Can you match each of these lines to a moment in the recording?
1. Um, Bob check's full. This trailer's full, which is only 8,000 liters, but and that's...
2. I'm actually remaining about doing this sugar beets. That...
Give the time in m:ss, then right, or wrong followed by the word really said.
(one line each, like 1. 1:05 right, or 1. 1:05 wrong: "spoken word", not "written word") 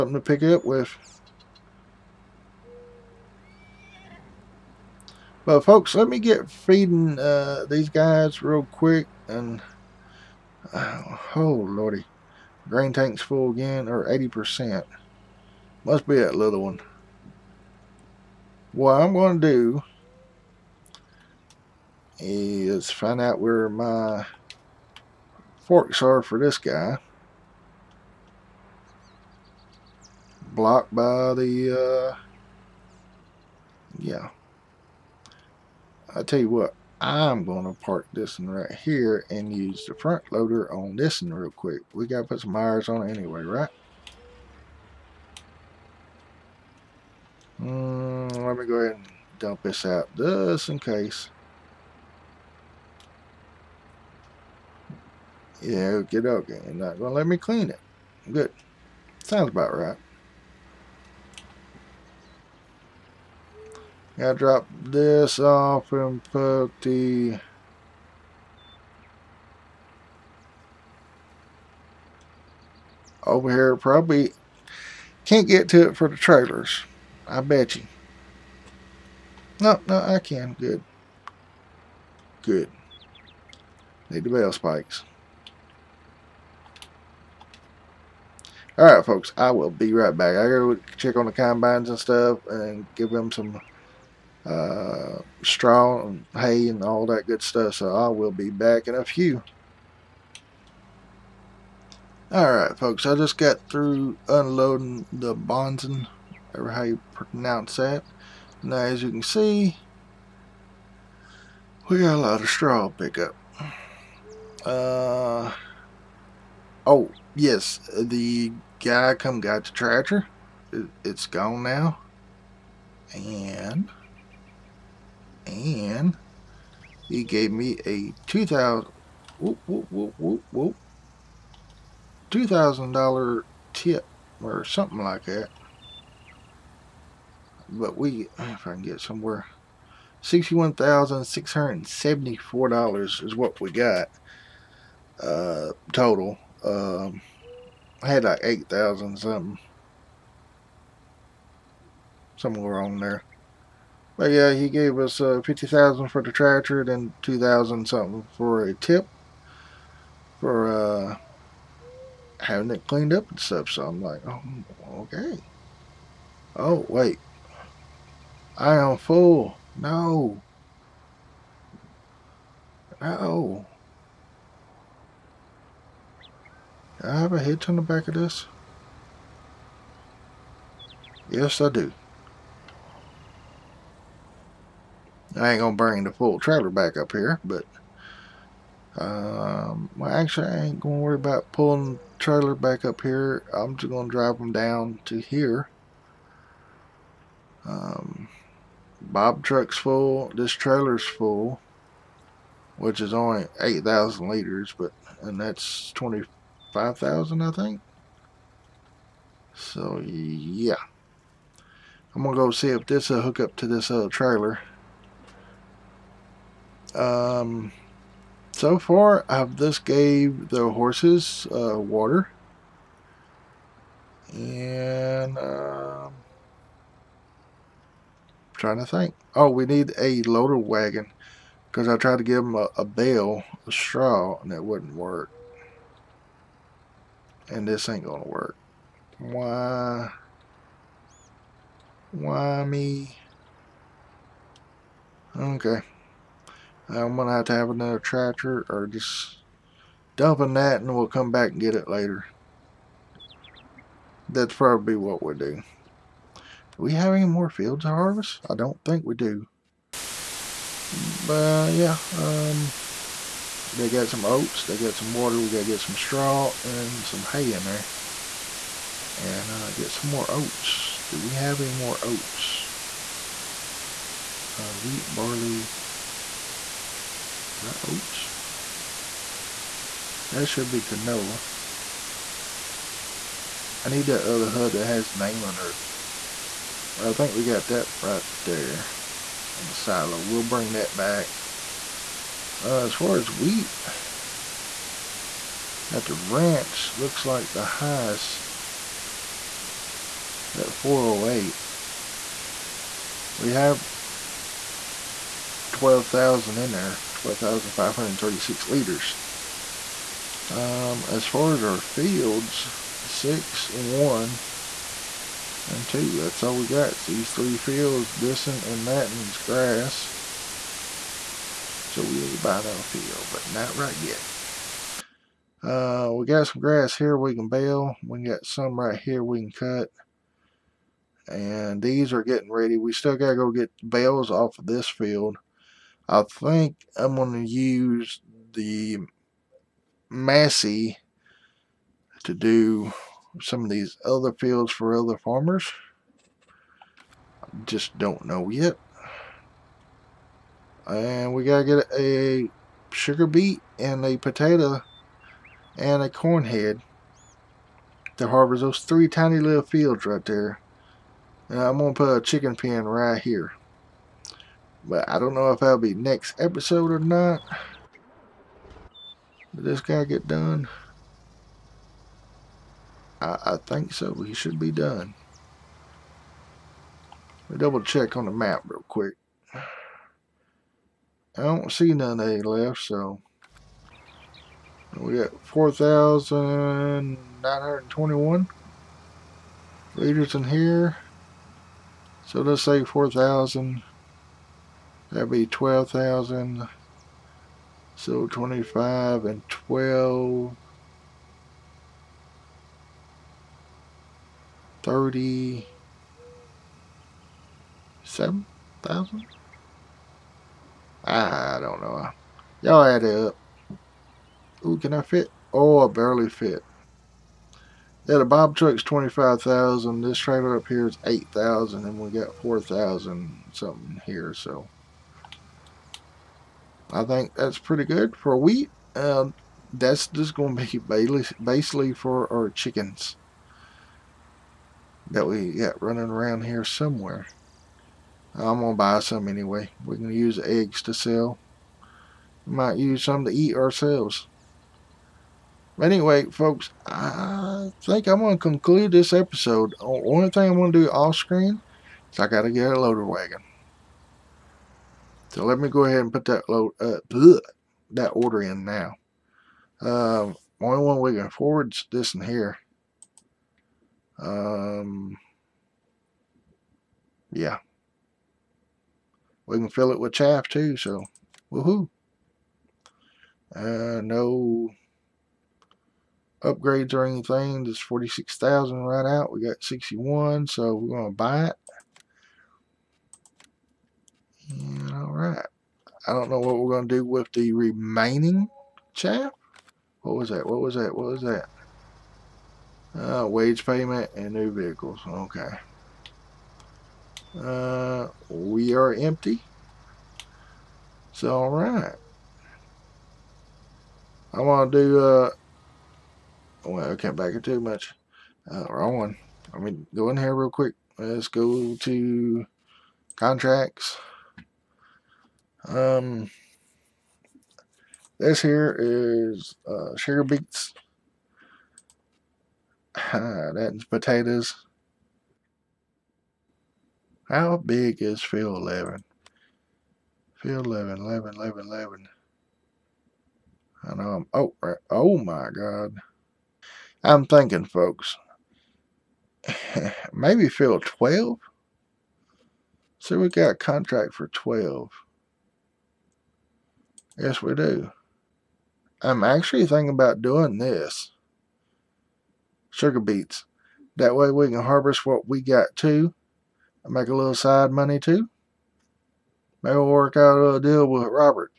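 1. 3:17 wrong: "truck", not "check"
2. 9:09 wrong: "thinking", not "remaining".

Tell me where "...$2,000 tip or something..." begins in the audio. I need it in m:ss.
2:12.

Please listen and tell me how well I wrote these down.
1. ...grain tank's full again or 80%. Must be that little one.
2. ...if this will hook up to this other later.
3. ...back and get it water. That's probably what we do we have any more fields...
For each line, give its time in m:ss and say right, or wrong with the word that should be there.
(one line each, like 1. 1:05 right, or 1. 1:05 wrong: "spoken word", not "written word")
1. 0:12 right
2. 3:32 wrong: "trailer", not "later"
3. 4:11 wrong: "later", not "water".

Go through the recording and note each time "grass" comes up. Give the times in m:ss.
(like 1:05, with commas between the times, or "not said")
5:19, 5:26.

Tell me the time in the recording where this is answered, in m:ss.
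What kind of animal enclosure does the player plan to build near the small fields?
6:02.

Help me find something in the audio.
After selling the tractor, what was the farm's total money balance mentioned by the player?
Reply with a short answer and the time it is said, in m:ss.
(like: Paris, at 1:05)
$61,674, at 2:20.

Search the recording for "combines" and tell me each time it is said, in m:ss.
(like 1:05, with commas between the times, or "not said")
1:31.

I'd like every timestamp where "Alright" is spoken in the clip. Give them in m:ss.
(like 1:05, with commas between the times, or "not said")
1:28, 1:42.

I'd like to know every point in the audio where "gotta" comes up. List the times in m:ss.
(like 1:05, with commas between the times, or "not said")
1:04, 1:30, 5:51.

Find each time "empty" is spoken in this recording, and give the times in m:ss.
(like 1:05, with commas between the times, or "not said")
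8:18.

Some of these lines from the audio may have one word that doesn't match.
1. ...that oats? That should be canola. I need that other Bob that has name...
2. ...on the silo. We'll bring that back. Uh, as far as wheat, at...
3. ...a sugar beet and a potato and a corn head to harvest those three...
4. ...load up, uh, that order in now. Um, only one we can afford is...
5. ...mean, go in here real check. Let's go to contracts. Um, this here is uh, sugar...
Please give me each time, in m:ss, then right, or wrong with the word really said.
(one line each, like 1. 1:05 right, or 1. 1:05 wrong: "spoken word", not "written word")
1. 4:37 wrong: "HUD", not "Bob"
2. 4:49 right
3. 5:51 right
4. 7:36 right
5. 8:29 wrong: "quick", not "check".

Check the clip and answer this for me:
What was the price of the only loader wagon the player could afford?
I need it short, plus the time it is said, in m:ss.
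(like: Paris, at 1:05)
46,000, at 7:57.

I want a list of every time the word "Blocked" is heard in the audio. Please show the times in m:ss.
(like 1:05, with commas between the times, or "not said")
0:30.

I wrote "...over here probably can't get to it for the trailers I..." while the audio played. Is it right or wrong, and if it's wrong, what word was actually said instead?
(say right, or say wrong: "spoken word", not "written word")
right.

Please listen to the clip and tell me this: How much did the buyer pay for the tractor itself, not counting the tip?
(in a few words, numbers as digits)
50000.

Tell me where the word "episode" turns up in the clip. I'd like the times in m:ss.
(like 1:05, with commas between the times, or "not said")
6:06, 7:29.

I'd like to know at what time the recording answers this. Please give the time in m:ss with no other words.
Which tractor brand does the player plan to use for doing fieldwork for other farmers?
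5:40.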